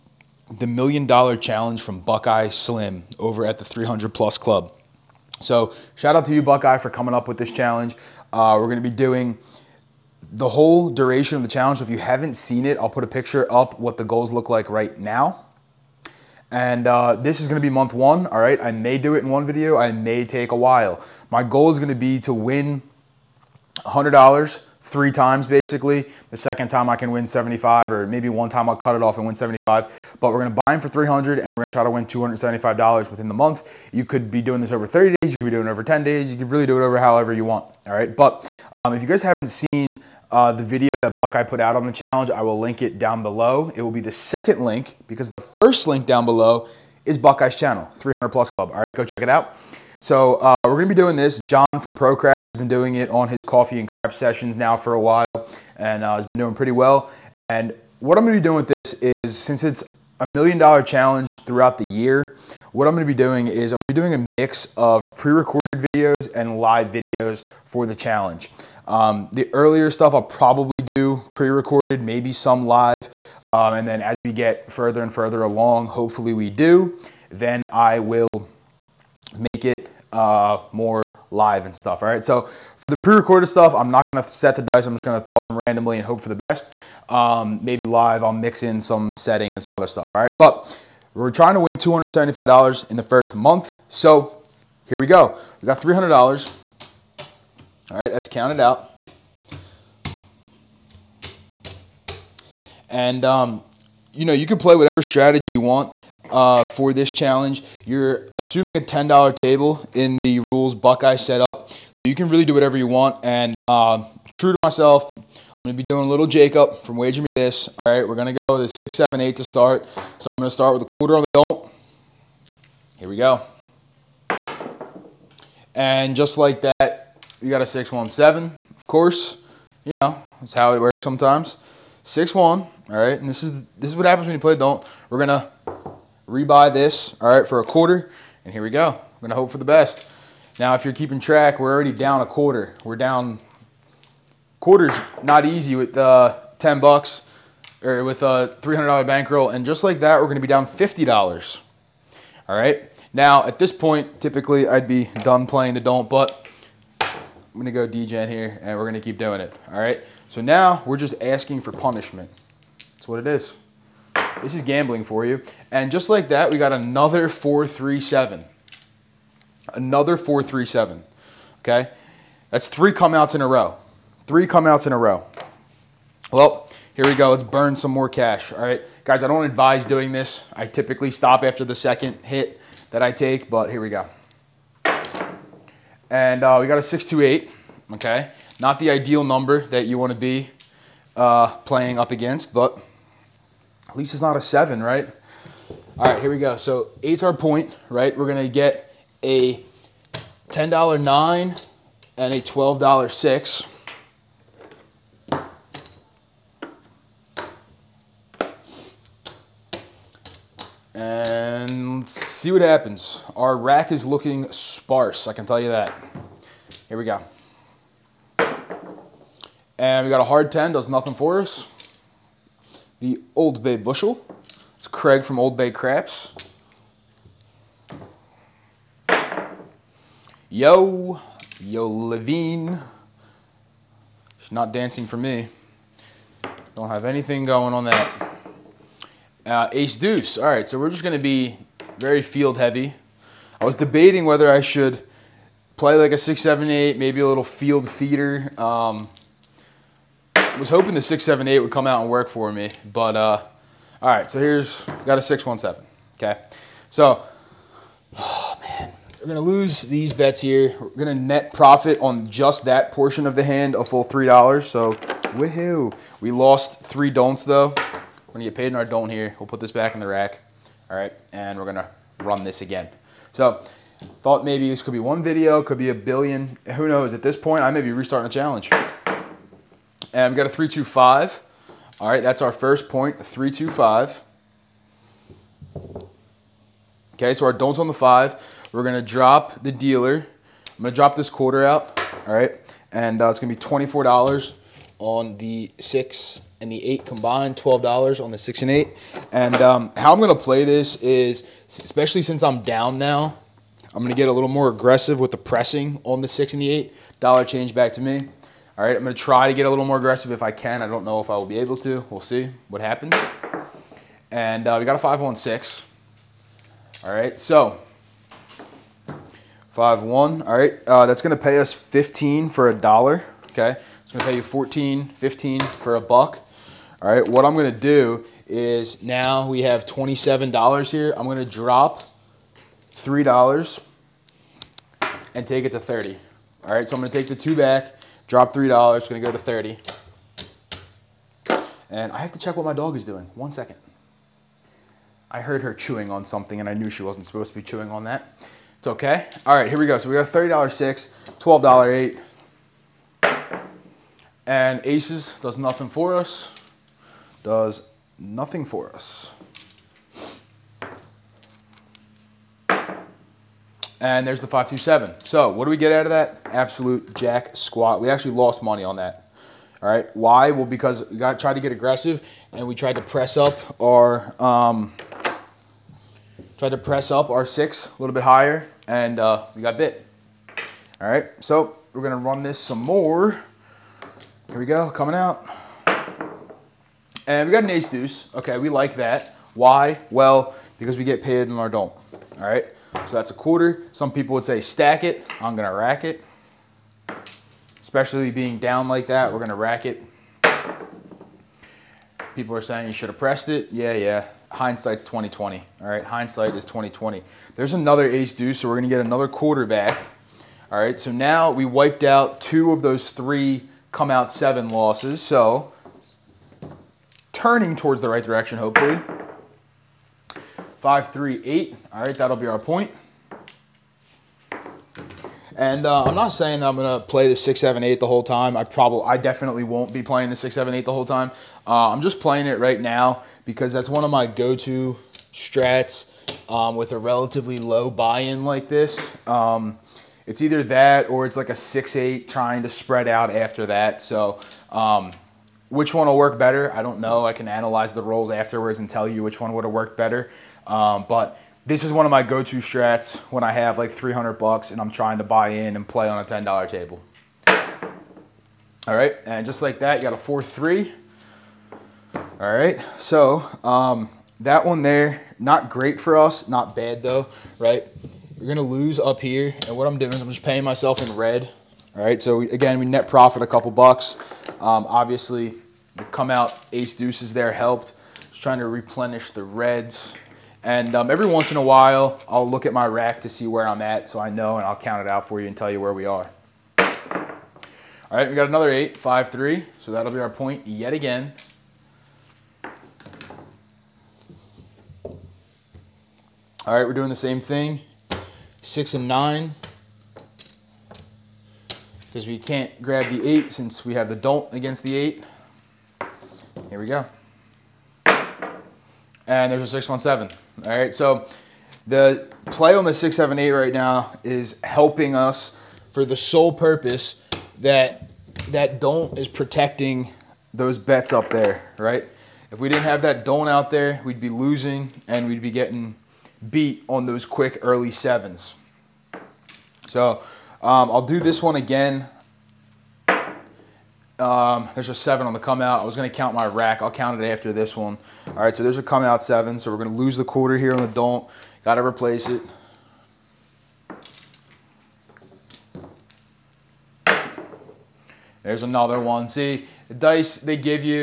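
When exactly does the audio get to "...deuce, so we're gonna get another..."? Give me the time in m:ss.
6:48.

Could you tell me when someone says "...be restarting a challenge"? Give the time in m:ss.
4:37.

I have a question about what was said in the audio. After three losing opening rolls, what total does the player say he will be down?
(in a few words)
$50.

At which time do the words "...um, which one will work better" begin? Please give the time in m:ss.
7:24.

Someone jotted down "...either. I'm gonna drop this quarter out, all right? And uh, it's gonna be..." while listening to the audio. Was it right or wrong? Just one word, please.
wrong.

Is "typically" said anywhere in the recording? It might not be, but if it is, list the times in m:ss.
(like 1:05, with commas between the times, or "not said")
2:34, 3:00.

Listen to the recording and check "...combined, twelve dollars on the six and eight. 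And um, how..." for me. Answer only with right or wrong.
right.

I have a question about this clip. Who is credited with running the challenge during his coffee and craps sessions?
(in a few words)
John from Pro Craps.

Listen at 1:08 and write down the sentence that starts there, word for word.
Um, the earlier stuff I'll probably do pre-recorded, maybe some live.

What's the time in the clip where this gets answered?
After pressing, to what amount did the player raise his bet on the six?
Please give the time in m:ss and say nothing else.
5:35.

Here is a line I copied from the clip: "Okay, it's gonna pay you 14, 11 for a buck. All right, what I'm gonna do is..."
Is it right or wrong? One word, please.
wrong.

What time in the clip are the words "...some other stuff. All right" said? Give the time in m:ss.
1:29.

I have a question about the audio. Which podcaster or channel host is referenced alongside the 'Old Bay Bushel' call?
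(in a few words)
Craig.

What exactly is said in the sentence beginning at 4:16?
So, oh man, we're gonna lose these bets here.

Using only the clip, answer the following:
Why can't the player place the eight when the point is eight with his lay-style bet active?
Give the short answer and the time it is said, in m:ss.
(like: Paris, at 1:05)
don't against the eight, at 8:23.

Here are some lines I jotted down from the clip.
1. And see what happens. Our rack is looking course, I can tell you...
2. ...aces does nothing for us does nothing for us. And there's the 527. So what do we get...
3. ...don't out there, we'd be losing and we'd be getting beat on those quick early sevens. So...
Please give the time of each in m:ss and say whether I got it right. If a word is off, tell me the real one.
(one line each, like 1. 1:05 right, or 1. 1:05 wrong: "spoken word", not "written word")
1. 3:30 wrong: "sparse", not "course"
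2. 5:54 right
3. 8:43 right.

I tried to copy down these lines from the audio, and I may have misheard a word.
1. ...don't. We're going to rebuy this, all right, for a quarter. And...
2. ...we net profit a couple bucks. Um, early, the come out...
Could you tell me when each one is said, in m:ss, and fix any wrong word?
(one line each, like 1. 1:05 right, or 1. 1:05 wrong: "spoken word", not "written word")
1. 2:14 right
2. 7:52 wrong: "obviously", not "early".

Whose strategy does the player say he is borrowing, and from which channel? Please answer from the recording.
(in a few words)
Jacob from Wager Me This.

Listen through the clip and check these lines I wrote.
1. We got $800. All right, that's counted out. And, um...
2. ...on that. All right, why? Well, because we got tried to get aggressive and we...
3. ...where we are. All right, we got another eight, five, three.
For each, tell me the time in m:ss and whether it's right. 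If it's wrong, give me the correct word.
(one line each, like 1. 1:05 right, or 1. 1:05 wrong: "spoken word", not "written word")
1. 1:35 wrong: "300", not "800"
2. 6:08 right
3. 8:05 right.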